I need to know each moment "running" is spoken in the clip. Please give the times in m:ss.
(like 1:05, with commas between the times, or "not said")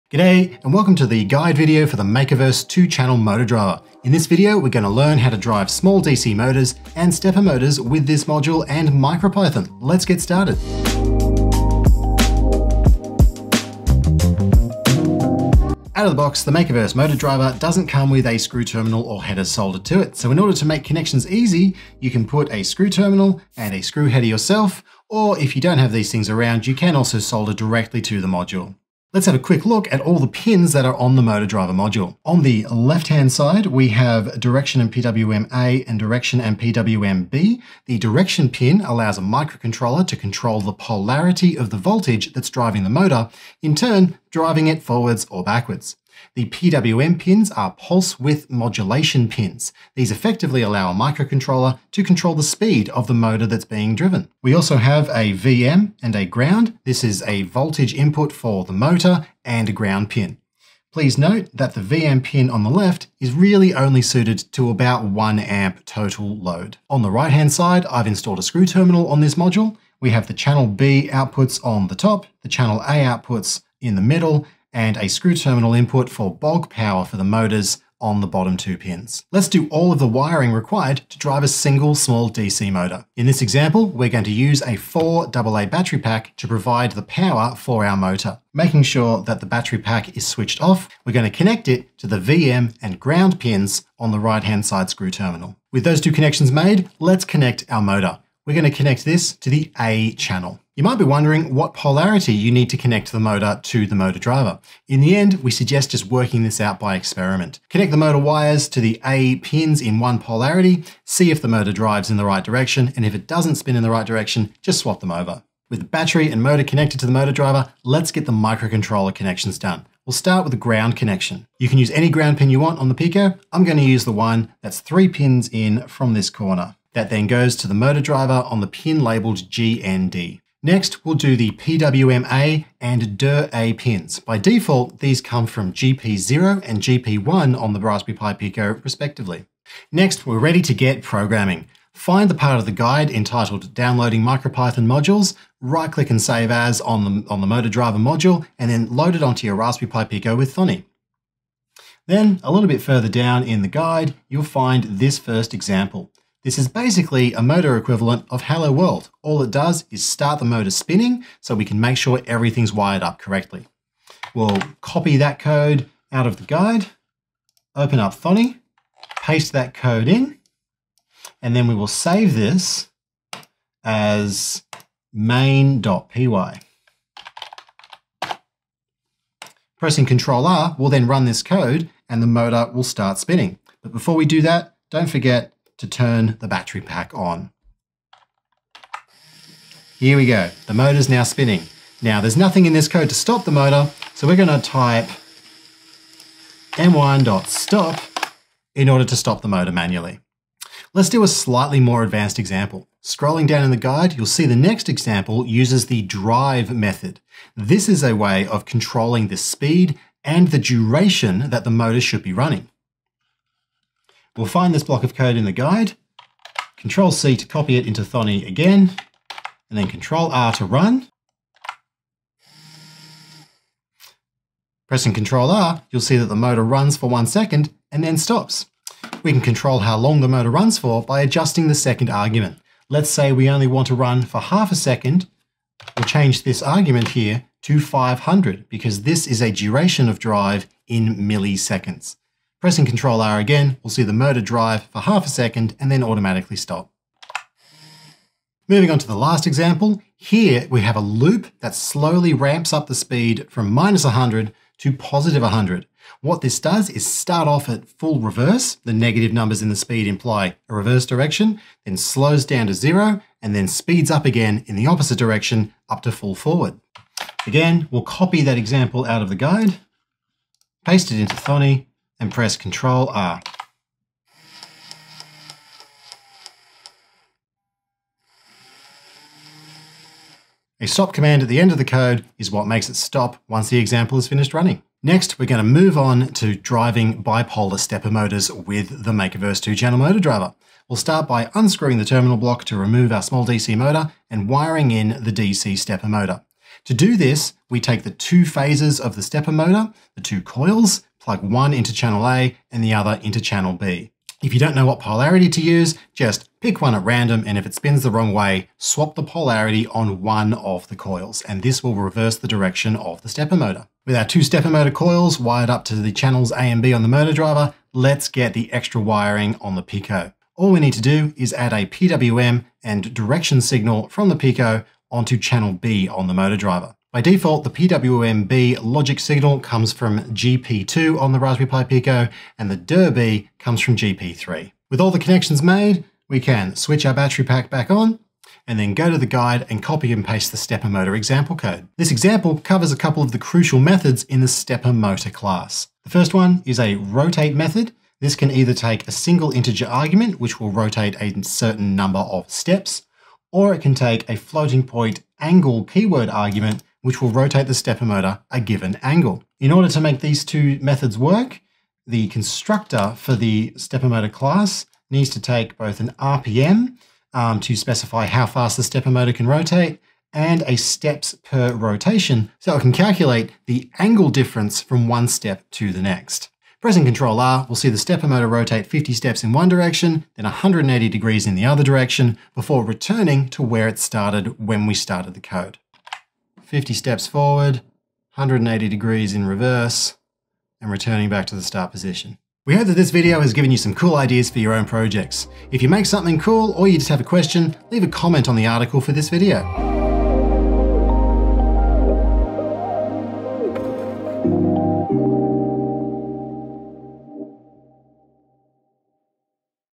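3:32, 4:44.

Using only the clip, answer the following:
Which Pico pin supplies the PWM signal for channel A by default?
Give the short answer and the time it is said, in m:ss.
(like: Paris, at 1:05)
GP0, at 2:15.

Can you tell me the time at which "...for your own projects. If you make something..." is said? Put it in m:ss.
6:34.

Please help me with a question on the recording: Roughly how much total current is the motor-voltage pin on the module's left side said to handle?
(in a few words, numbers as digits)
1 amp.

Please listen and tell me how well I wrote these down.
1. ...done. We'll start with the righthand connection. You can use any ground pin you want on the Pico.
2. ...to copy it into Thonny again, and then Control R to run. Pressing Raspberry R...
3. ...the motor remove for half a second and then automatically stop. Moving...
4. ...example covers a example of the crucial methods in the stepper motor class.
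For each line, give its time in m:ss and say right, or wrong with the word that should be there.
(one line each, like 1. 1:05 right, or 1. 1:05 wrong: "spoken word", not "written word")
1. 1:59 wrong: "ground", not "righthand"
2. 3:37 wrong: "Control", not "Raspberry"
3. 4:04 wrong: "drive", not "remove"
4. 5:42 wrong: "couple", not "example".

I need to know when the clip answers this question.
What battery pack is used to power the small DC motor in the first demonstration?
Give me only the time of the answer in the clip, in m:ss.
1:24.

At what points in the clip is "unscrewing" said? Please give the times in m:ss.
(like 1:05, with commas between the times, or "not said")
4:51.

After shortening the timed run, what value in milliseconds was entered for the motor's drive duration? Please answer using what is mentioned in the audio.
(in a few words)
500.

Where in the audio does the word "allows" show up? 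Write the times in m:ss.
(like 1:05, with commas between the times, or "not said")
0:38, 0:50.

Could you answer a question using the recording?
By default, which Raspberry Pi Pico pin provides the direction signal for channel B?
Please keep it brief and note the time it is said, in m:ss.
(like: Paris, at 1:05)
GP3, at 5:33.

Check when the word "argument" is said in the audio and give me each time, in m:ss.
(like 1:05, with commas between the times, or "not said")
3:52, 3:56, 5:49, 5:56.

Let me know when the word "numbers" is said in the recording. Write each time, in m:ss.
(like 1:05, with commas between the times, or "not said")
4:19, 5:51.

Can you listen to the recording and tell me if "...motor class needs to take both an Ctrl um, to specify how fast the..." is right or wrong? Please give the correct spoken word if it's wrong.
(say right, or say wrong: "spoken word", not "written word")
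wrong: "RPM", not "Ctrl".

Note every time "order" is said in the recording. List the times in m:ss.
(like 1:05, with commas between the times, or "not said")
0:20, 3:18, 5:59.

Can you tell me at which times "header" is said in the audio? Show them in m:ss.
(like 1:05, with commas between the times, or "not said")
0:19, 0:24.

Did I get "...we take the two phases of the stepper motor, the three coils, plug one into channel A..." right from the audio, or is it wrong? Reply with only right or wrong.
wrong.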